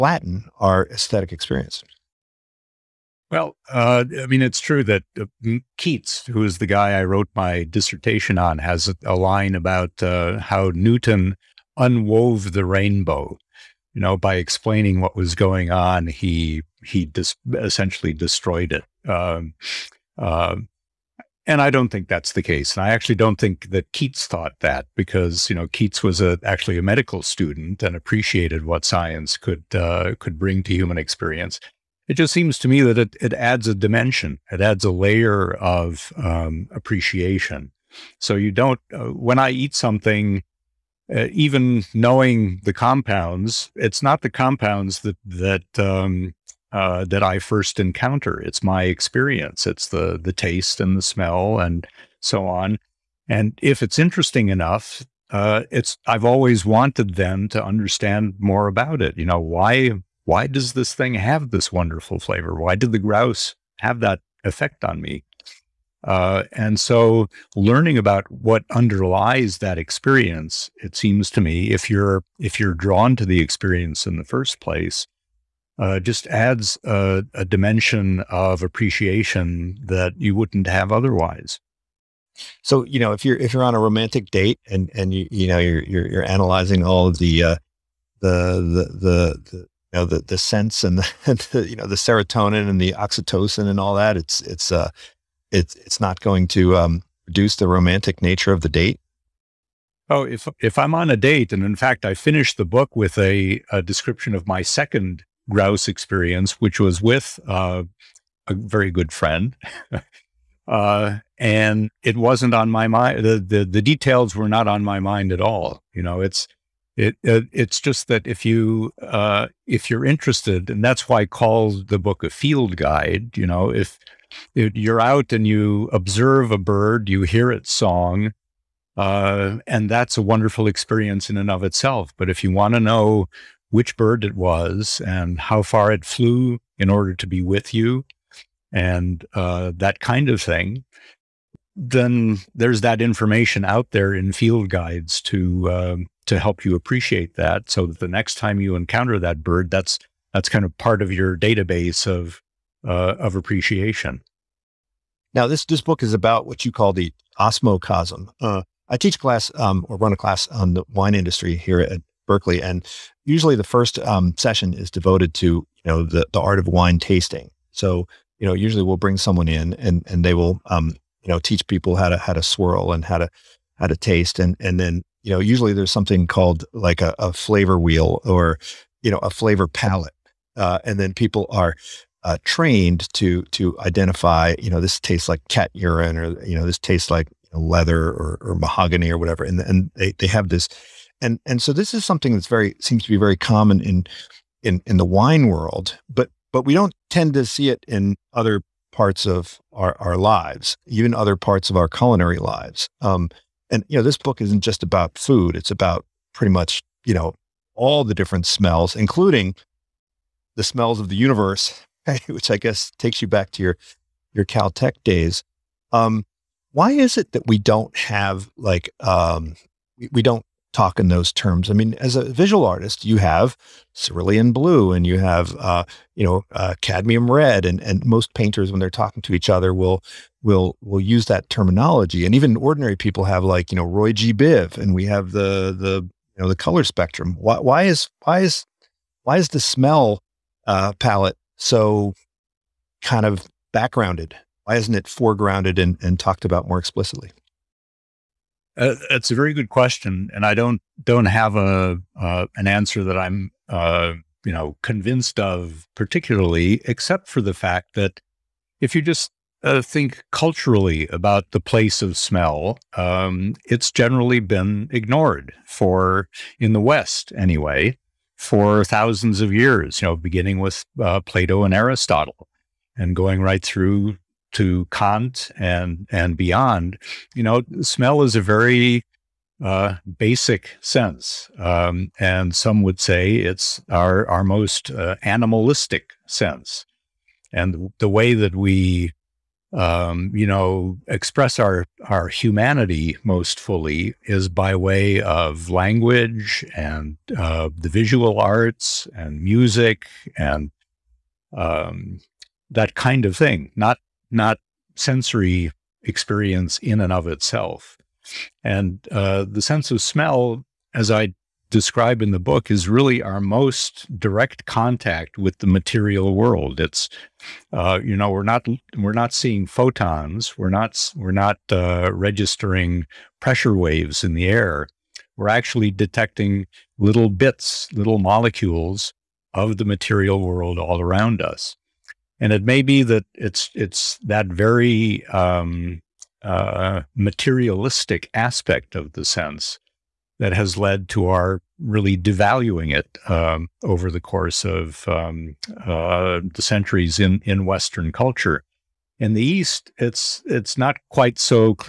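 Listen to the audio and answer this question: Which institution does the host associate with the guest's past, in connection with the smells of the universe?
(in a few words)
Caltech.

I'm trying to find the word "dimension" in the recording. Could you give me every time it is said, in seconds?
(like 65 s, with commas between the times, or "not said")
33 s, 77 s.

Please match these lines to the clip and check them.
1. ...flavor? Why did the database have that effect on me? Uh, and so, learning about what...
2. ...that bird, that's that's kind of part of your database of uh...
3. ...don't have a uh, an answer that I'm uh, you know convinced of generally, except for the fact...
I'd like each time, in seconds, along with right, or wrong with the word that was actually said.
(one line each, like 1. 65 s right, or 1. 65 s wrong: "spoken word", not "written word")
1. 62 s wrong: "grouse", not "database"
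2. 149 s right
3. 251 s wrong: "particularly", not "generally".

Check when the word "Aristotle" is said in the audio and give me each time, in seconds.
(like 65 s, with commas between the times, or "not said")
271 s.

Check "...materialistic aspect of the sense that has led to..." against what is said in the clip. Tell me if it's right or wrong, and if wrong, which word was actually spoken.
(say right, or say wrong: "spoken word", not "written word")
right.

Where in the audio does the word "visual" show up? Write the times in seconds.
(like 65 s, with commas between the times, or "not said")
222 s, 297 s.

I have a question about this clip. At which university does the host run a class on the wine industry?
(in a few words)
Berkeley.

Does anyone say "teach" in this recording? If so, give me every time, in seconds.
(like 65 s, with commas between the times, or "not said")
158 s, 171 s.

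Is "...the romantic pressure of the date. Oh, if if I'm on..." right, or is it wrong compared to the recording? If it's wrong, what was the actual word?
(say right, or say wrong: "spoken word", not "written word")
wrong: "nature", not "pressure".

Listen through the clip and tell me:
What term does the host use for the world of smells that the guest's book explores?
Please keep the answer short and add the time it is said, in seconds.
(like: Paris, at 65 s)
osmocosm, at 157 s.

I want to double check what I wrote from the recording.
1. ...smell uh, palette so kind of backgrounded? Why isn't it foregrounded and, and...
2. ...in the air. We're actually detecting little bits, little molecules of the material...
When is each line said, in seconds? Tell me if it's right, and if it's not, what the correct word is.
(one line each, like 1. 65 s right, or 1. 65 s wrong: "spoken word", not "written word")
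1. 239 s right
2. 324 s right.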